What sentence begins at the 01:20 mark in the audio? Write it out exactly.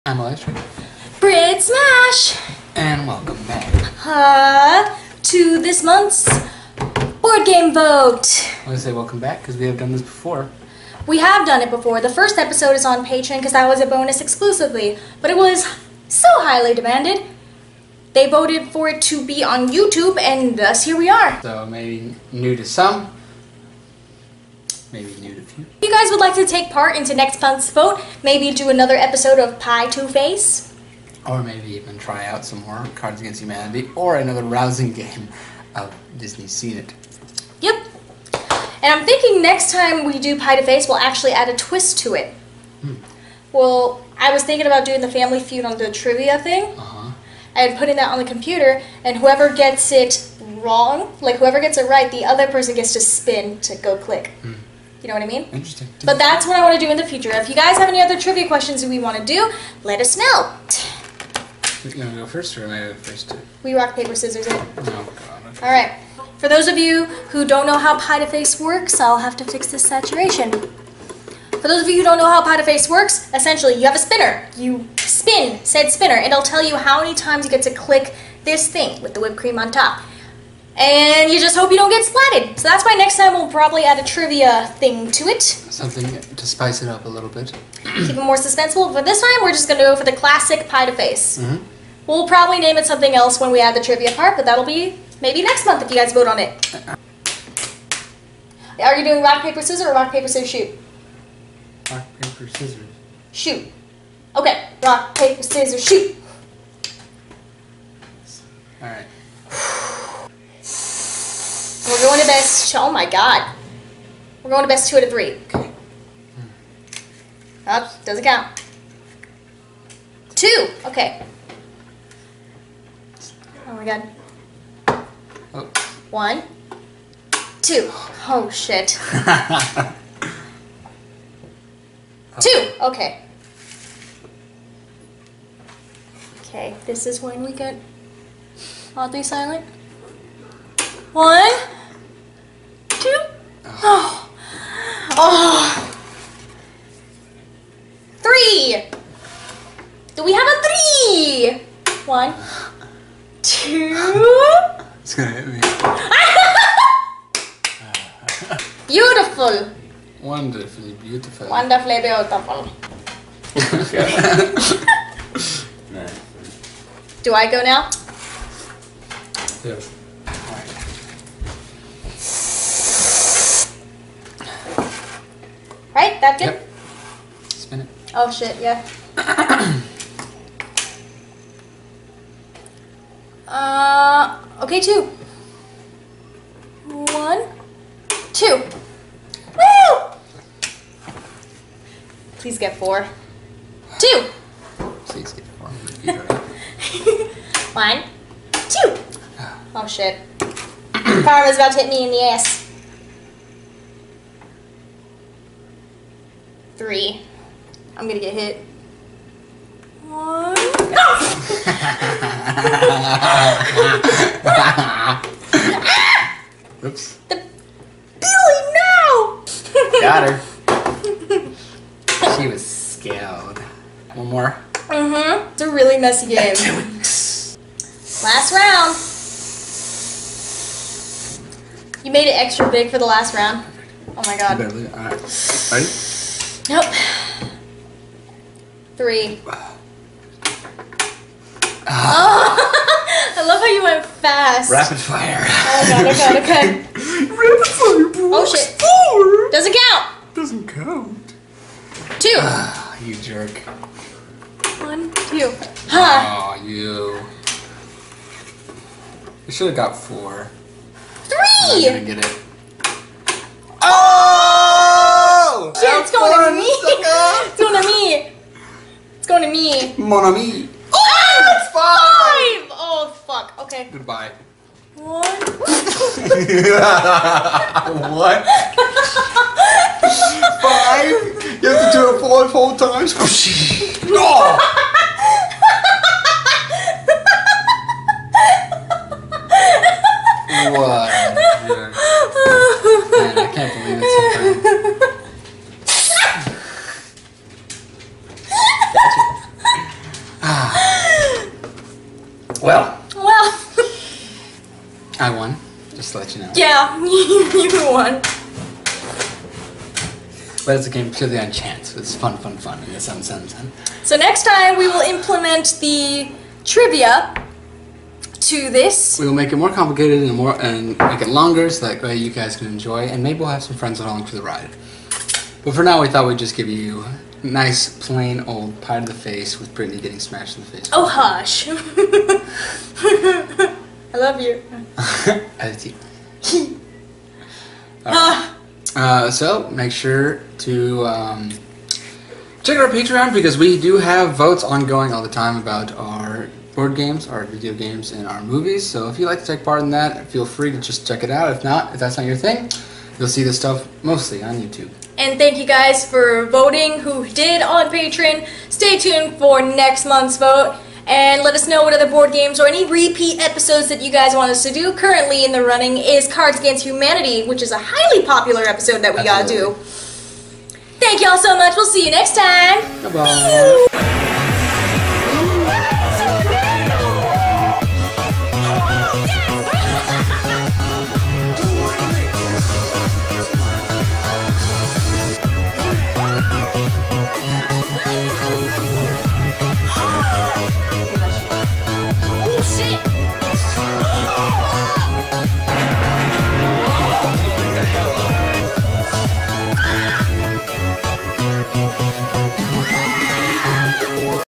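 And you just hope you don't get splatted.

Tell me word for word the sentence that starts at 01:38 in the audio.
Are you doing rock, paper, scissors or rock, paper, scissors, shoot?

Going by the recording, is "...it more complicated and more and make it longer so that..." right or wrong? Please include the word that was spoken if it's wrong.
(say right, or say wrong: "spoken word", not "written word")
right.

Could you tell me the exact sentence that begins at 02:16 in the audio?
Okay, this is when we get oddly silent.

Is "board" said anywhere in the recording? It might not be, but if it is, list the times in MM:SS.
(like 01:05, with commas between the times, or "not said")
00:07, 05:46, 06:02.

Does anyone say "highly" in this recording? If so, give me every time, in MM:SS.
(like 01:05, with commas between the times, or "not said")
00:16, 06:07.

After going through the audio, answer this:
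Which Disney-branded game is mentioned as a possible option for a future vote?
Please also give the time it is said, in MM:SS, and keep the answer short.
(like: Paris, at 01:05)
Disney's Scene It, at 00:36.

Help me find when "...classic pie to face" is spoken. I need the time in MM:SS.
01:30.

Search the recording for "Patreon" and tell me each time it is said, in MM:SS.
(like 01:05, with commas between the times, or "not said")
00:13, 05:42, 05:57.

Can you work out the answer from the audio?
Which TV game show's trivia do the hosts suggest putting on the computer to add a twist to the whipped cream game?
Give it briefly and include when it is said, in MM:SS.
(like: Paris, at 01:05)
Family Feud, at 00:45.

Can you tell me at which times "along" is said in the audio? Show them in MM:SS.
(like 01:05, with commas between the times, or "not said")
05:23.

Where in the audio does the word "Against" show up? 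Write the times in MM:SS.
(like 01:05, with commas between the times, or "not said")
00:33, 06:06.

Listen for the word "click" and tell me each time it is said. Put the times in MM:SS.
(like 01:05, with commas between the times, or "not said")
00:53, 01:17.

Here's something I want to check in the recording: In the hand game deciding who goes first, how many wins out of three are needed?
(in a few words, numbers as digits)
2.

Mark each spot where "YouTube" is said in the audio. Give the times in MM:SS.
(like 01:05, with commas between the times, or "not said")
00:19, 05:54.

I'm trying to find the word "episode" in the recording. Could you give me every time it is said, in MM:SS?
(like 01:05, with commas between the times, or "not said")
00:12, 00:28, 06:03, 06:08.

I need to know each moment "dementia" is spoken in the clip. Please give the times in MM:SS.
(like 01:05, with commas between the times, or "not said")
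not said.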